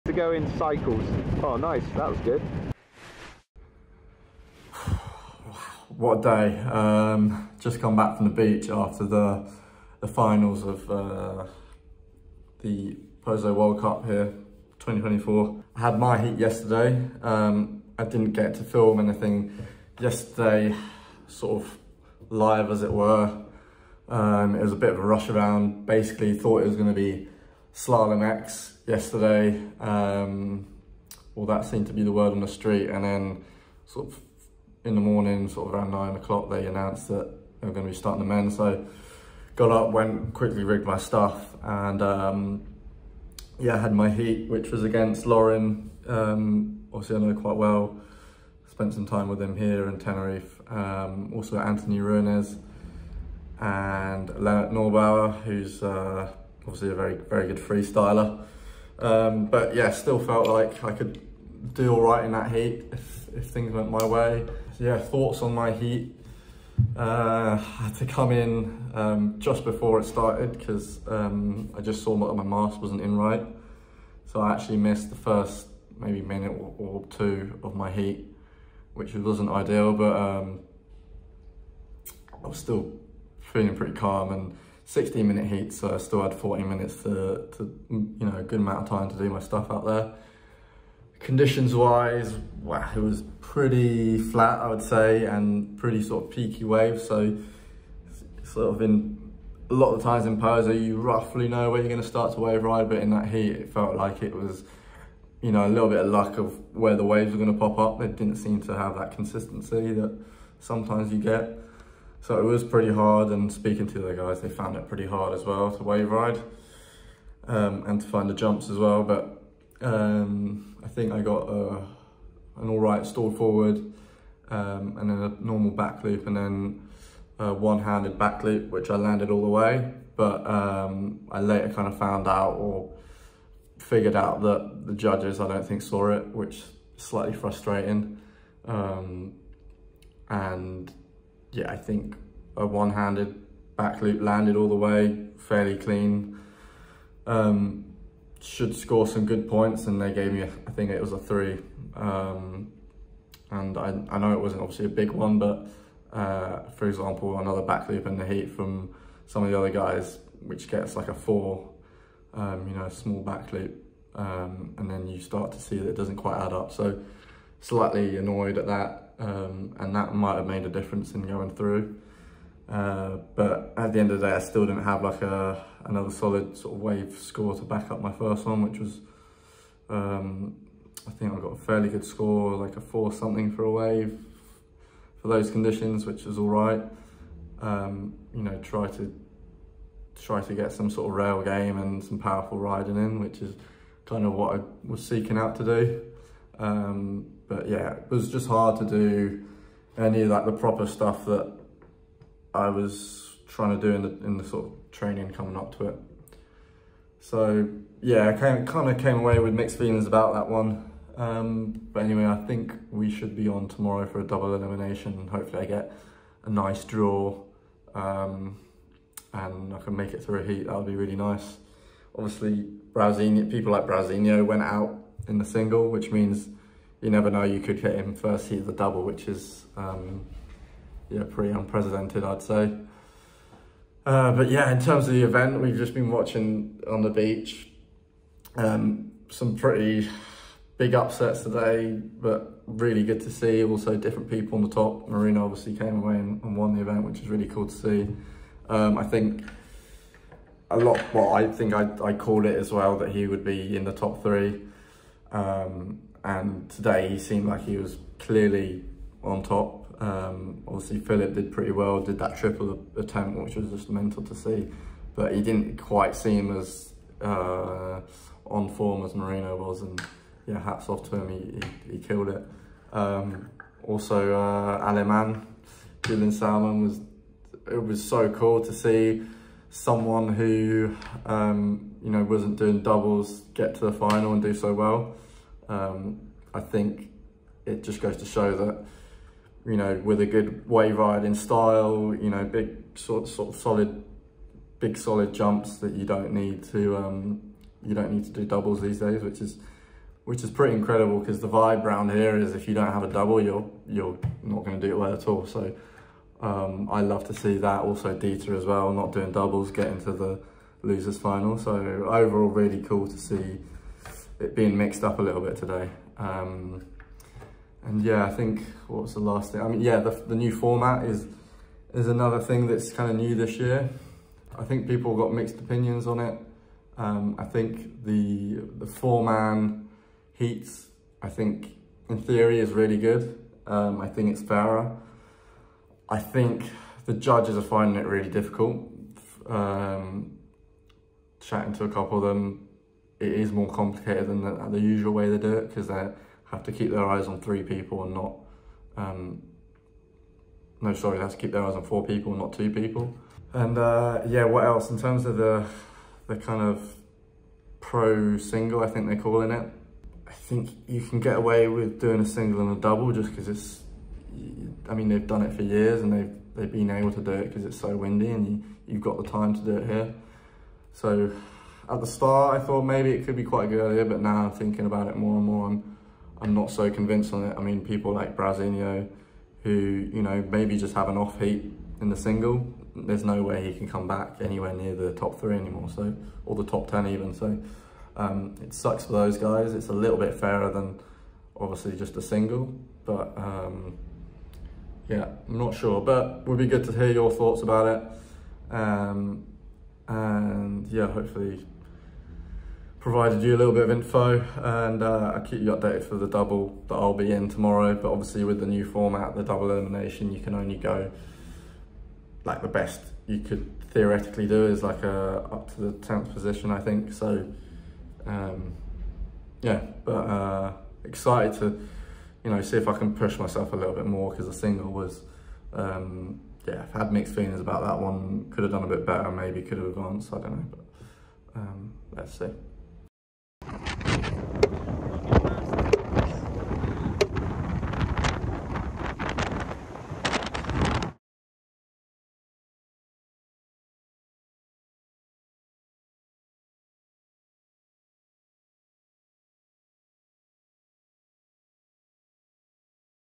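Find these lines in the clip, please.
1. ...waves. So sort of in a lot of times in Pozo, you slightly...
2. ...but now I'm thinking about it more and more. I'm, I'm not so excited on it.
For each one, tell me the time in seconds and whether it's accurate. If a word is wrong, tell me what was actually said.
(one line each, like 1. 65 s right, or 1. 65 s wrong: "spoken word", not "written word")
1. 96 s wrong: "roughly", not "slightly"
2. 374 s wrong: "convinced", not "excited".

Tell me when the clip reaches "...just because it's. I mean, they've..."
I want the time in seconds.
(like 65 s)
363 s.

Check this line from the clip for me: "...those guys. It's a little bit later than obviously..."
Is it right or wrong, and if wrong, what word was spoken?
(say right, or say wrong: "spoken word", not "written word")
wrong: "fairer", not "later".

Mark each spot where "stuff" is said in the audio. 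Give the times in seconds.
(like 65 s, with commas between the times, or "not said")
40 s, 89 s, 200 s.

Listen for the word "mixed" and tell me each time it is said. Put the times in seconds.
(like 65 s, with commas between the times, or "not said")
209 s, 314 s, 325 s, 427 s.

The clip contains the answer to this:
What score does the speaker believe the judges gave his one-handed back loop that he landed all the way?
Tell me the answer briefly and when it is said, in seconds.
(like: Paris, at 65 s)
3, at 151 s.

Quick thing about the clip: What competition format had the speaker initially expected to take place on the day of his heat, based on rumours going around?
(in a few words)
Slalom X.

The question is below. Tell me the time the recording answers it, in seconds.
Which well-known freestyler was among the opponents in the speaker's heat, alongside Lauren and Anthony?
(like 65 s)
54 s.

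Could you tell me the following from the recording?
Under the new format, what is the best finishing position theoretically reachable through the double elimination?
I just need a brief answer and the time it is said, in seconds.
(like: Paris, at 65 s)
10th, at 415 s.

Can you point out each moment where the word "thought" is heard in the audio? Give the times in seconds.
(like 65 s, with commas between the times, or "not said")
26 s, 64 s, 372 s, 397 s.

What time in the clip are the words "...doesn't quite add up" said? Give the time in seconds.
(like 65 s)
165 s.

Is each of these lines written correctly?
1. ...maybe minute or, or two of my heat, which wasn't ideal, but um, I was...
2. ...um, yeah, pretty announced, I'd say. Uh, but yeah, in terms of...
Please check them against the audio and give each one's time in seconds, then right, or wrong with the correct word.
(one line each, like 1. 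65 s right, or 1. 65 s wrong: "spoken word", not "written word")
1. 75 s right
2. 229 s wrong: "unprecedented", not "announced".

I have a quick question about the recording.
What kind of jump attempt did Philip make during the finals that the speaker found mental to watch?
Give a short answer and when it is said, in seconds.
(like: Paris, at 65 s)
triple, at 262 s.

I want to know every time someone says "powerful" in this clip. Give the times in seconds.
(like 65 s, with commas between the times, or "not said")
192 s.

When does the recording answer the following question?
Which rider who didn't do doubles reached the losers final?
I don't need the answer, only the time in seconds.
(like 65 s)
308 s.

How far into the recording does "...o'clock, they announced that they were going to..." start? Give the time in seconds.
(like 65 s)
36 s.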